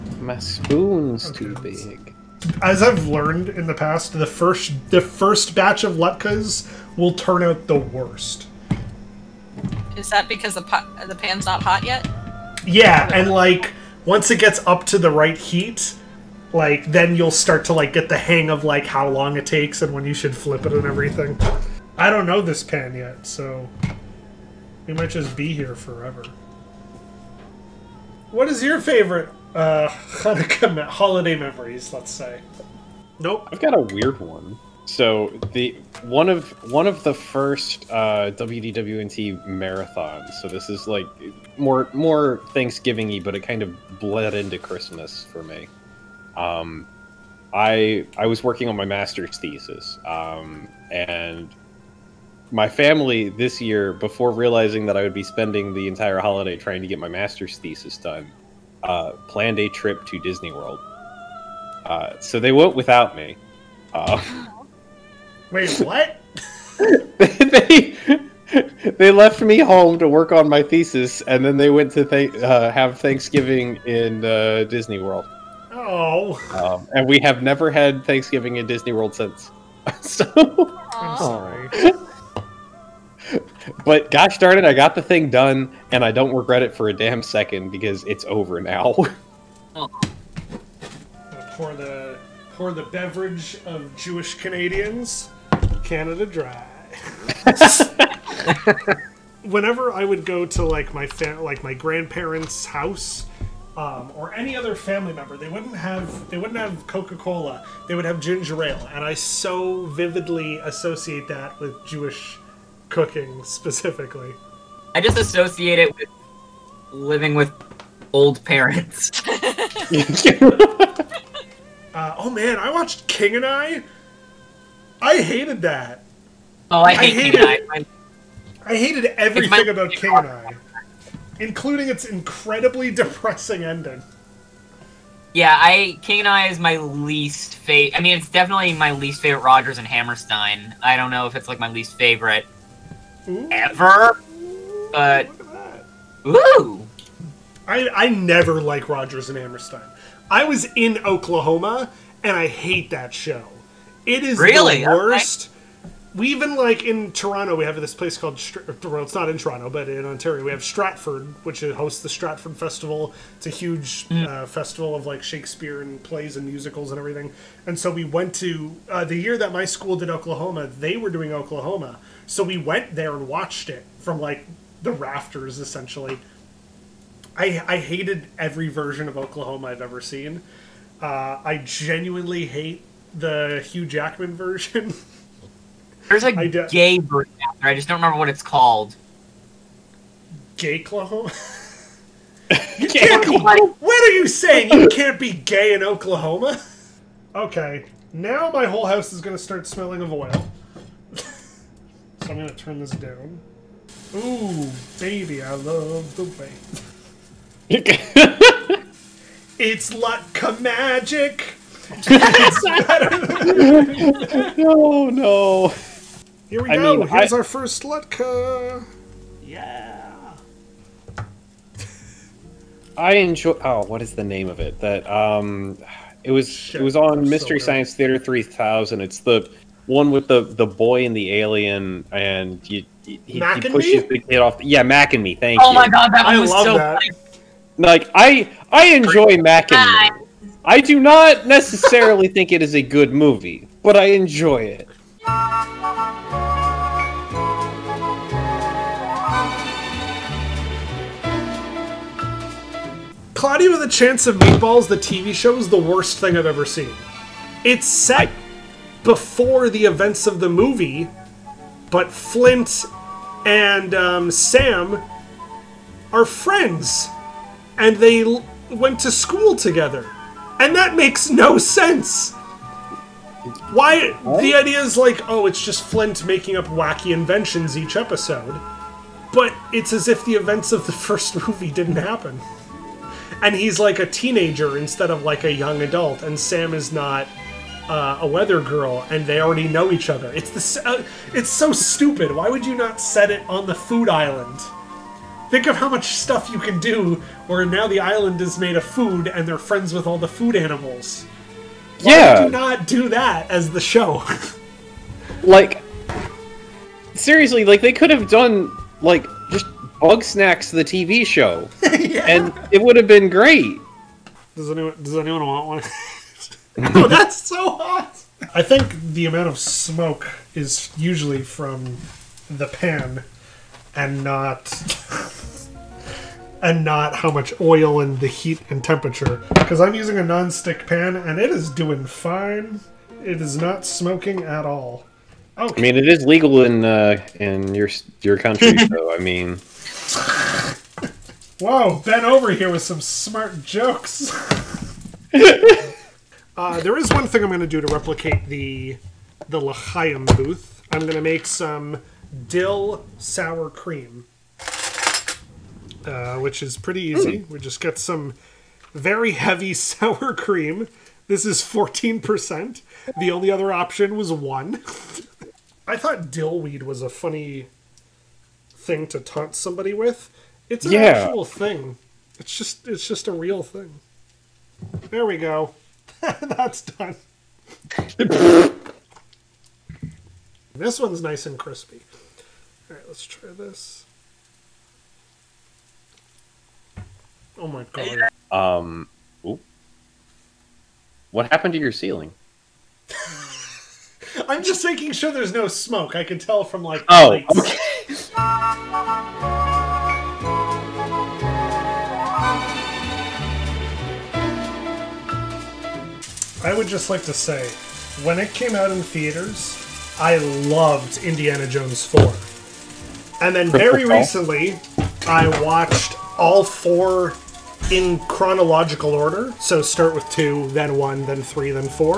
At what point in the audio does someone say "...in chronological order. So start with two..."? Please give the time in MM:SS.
06:57.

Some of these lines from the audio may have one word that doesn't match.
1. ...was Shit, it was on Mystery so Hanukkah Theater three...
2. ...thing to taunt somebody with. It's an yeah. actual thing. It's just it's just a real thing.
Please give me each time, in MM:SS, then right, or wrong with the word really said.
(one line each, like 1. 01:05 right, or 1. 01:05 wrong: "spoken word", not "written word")
1. 03:46 wrong: "Science", not "Hanukkah"
2. 06:08 right.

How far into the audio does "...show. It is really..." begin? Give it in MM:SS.
02:33.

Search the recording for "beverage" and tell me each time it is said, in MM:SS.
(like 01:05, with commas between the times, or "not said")
01:32.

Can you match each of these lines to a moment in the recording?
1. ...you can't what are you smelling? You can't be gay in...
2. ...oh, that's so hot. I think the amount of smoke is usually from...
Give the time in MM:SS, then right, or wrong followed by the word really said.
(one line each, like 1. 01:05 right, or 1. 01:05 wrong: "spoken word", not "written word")
1. 03:12 wrong: "saying", not "smelling"
2. 05:16 right.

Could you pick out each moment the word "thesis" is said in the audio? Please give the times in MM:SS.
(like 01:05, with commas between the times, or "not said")
00:49, 00:57, 01:10.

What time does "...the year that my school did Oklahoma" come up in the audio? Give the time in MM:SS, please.
02:49.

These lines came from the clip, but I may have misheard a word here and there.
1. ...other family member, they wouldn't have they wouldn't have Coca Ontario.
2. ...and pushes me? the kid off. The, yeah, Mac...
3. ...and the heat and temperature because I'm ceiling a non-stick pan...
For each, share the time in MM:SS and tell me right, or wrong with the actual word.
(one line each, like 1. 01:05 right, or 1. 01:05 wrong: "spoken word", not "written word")
1. 01:44 wrong: "Cola", not "Ontario"
2. 03:53 right
3. 05:27 wrong: "using", not "ceiling".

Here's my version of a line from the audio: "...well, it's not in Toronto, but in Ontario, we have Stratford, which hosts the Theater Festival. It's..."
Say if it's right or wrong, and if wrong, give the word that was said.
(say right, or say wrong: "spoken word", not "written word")
wrong: "Stratford", not "Theater".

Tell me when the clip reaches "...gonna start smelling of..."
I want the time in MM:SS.
03:19.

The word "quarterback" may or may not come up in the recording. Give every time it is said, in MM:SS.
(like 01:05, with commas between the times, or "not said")
not said.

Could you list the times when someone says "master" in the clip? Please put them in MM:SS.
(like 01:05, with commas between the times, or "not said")
00:48, 00:57.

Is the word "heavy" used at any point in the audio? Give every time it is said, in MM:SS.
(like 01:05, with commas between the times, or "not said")
05:59.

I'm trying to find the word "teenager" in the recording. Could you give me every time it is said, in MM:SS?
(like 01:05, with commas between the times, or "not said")
04:44.